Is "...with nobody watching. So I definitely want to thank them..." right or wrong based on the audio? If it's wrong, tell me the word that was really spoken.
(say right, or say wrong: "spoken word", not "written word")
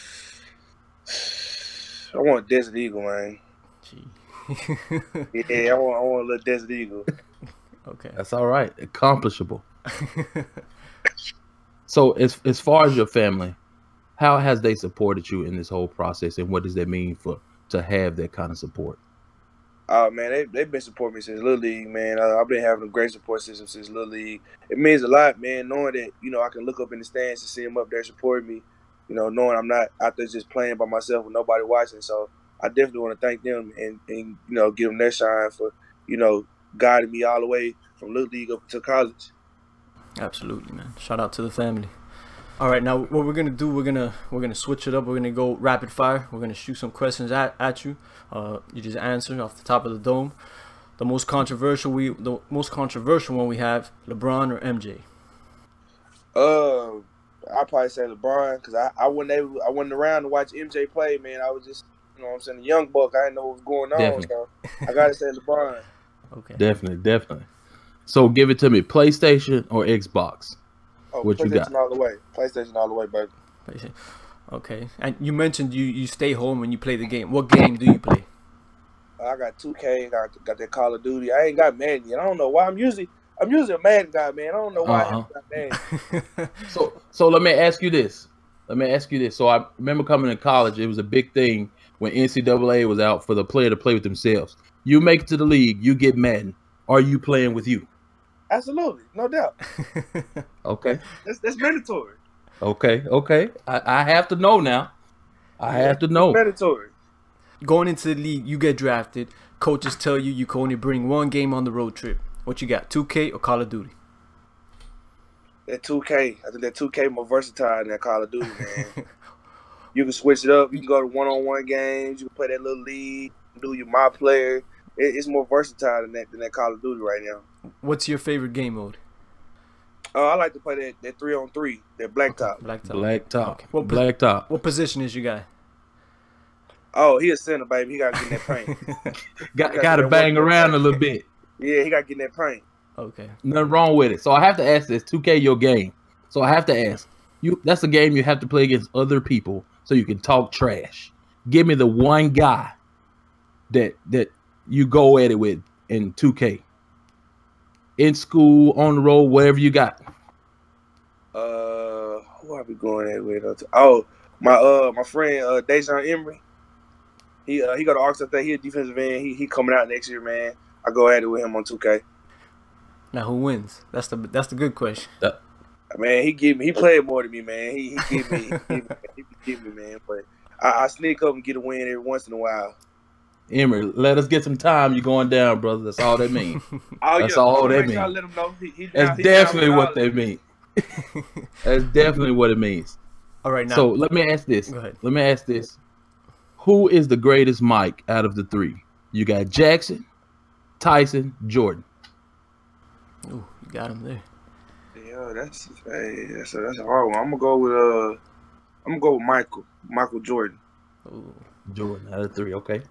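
right.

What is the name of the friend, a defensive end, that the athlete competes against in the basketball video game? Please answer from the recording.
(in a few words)
Dejon Emery.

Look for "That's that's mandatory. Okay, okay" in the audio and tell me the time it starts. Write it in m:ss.
1:41.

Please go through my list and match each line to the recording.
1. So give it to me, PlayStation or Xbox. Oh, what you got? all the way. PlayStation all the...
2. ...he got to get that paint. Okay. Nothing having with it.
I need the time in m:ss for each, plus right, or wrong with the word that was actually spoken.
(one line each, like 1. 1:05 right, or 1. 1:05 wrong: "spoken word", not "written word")
1. 1:08 right
2. 2:21 wrong: "wrong", not "having".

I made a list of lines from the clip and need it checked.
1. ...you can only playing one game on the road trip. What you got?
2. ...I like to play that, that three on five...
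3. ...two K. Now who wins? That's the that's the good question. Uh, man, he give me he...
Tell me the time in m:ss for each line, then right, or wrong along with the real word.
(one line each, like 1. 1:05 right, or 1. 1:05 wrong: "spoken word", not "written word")
1. 1:50 wrong: "bring", not "playing"
2. 2:10 wrong: "three", not "five"
3. 2:51 right.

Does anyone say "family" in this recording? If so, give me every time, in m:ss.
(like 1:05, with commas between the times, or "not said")
0:13, 0:41.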